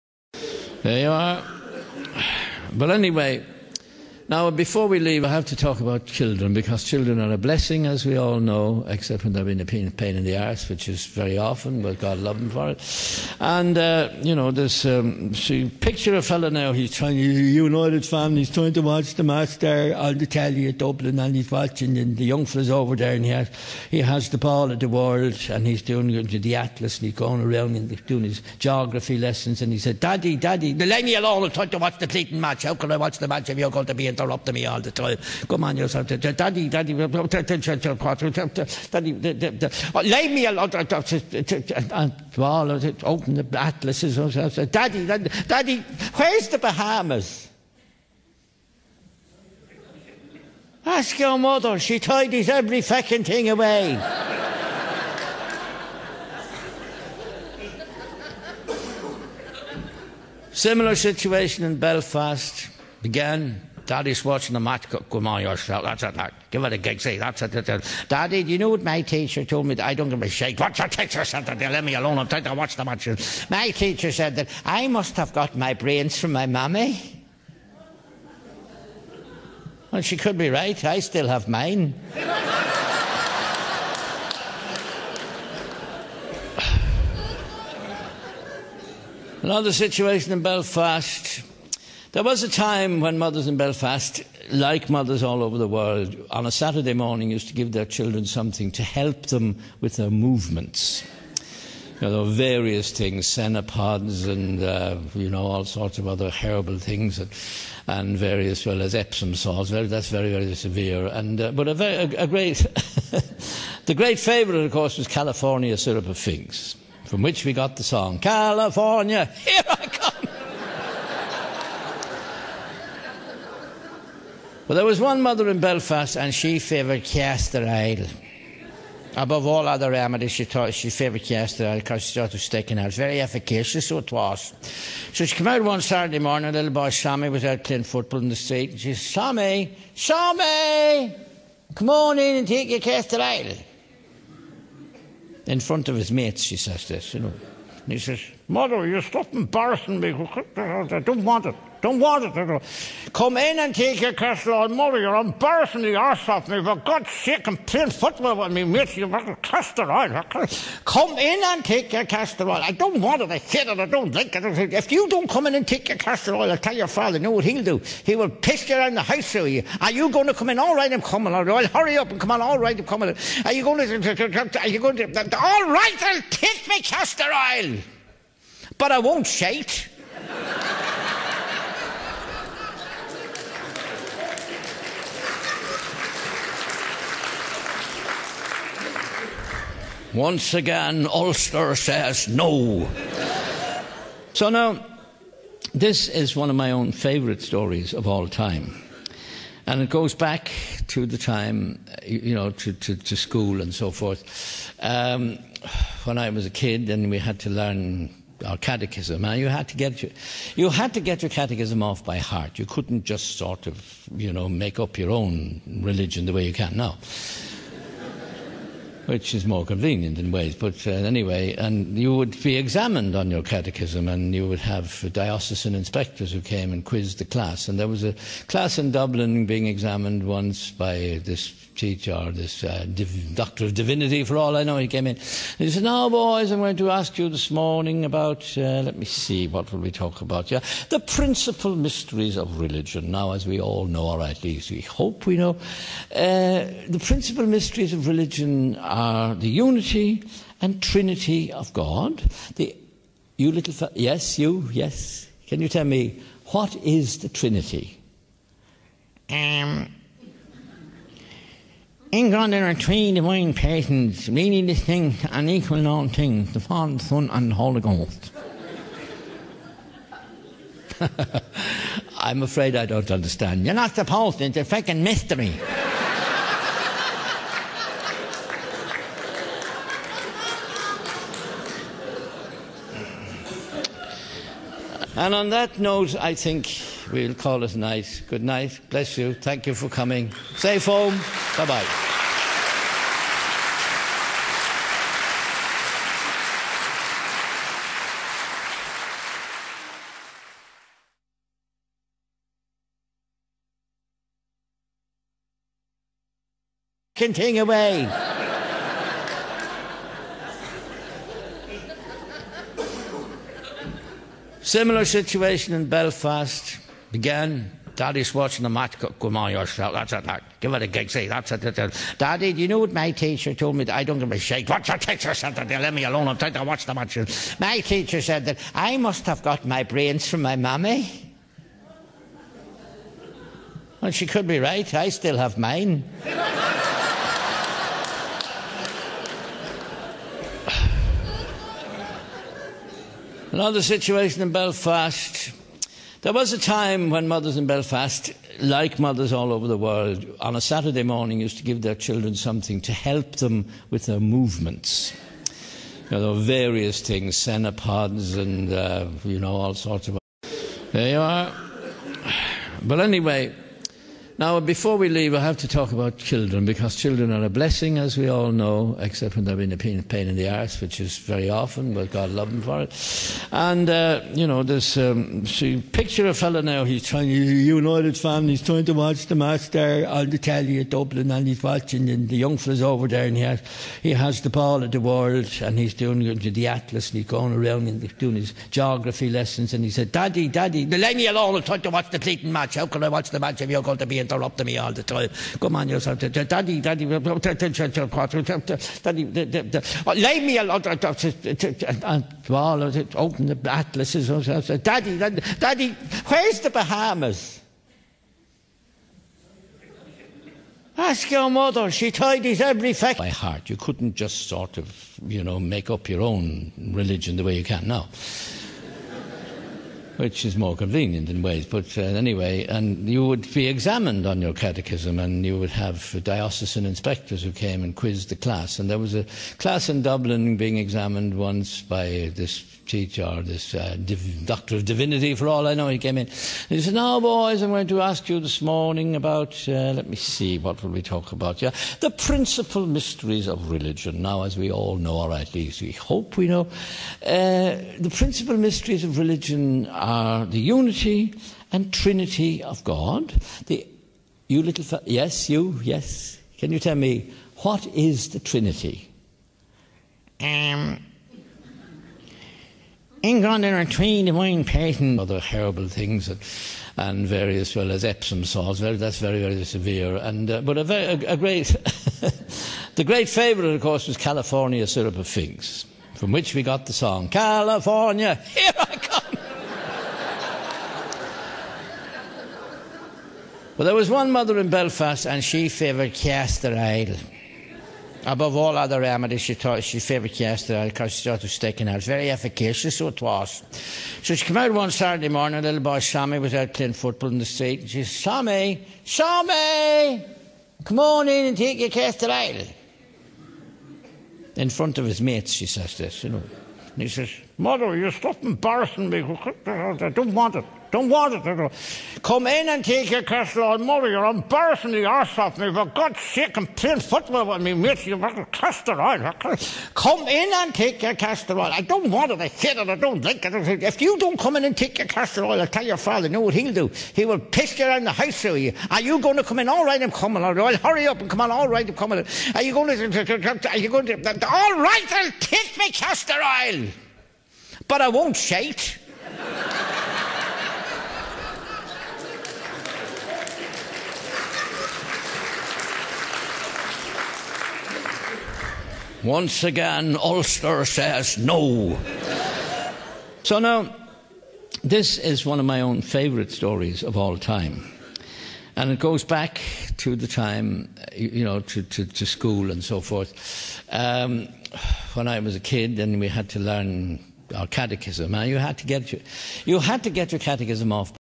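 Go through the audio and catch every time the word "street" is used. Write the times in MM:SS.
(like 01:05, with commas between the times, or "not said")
02:18, 08:17.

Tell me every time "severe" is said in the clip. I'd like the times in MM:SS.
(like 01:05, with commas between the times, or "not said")
01:50, 07:49.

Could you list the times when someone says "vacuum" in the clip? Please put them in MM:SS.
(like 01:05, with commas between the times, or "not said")
not said.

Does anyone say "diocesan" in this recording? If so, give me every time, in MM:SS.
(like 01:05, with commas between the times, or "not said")
03:45, 07:06.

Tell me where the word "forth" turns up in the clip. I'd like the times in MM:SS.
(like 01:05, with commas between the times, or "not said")
03:23, 09:22.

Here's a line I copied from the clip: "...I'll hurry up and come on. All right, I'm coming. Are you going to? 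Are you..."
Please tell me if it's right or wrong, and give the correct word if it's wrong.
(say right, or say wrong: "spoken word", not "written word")
right.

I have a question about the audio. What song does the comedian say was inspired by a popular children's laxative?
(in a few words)
California, Here I Come.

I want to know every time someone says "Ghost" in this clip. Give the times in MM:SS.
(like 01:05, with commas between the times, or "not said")
04:27.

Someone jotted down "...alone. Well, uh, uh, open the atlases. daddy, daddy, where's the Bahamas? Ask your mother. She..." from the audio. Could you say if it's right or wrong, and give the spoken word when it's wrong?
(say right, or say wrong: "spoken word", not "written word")
right.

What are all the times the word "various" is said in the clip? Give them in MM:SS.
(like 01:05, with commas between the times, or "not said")
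01:42, 01:48, 05:56, 07:47.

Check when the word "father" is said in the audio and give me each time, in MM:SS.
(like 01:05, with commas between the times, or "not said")
02:46, 04:26, 08:45.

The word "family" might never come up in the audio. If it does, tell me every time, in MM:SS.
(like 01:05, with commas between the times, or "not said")
00:18, 06:18.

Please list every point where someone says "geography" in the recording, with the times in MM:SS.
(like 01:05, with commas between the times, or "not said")
00:28, 06:28.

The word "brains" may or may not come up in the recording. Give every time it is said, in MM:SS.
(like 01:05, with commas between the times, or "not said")
01:15, 05:29.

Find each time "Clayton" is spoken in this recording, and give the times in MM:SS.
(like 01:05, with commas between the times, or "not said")
00:32, 06:32.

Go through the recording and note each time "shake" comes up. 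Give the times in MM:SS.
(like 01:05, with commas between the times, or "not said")
02:59, 08:58.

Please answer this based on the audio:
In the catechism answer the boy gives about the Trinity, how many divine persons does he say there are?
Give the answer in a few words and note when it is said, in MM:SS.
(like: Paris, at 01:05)
3, at 04:22.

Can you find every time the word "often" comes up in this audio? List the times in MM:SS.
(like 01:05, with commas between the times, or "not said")
00:11, 06:11.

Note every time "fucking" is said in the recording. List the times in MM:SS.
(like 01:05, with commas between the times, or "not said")
00:52.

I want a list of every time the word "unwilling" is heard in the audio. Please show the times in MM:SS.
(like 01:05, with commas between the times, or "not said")
not said.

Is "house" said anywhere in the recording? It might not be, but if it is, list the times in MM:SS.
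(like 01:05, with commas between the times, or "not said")
02:49, 08:48.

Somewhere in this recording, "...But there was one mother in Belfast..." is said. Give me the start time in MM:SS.
02:04.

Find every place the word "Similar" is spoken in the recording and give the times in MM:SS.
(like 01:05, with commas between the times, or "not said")
01:00, 05:14.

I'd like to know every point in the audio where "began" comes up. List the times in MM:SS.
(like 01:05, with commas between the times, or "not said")
01:03, 05:17.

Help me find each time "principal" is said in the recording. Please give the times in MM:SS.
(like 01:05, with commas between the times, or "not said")
04:00, 04:07, 07:22, 07:28.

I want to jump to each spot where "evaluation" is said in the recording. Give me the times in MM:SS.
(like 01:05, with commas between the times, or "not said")
not said.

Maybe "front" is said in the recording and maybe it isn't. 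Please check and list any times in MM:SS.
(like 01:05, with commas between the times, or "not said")
02:25, 08:24.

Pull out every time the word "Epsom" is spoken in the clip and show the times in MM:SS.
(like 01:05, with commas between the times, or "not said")
01:48, 07:48.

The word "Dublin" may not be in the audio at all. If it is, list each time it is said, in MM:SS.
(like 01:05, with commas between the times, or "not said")
00:20, 03:48, 06:20, 07:10.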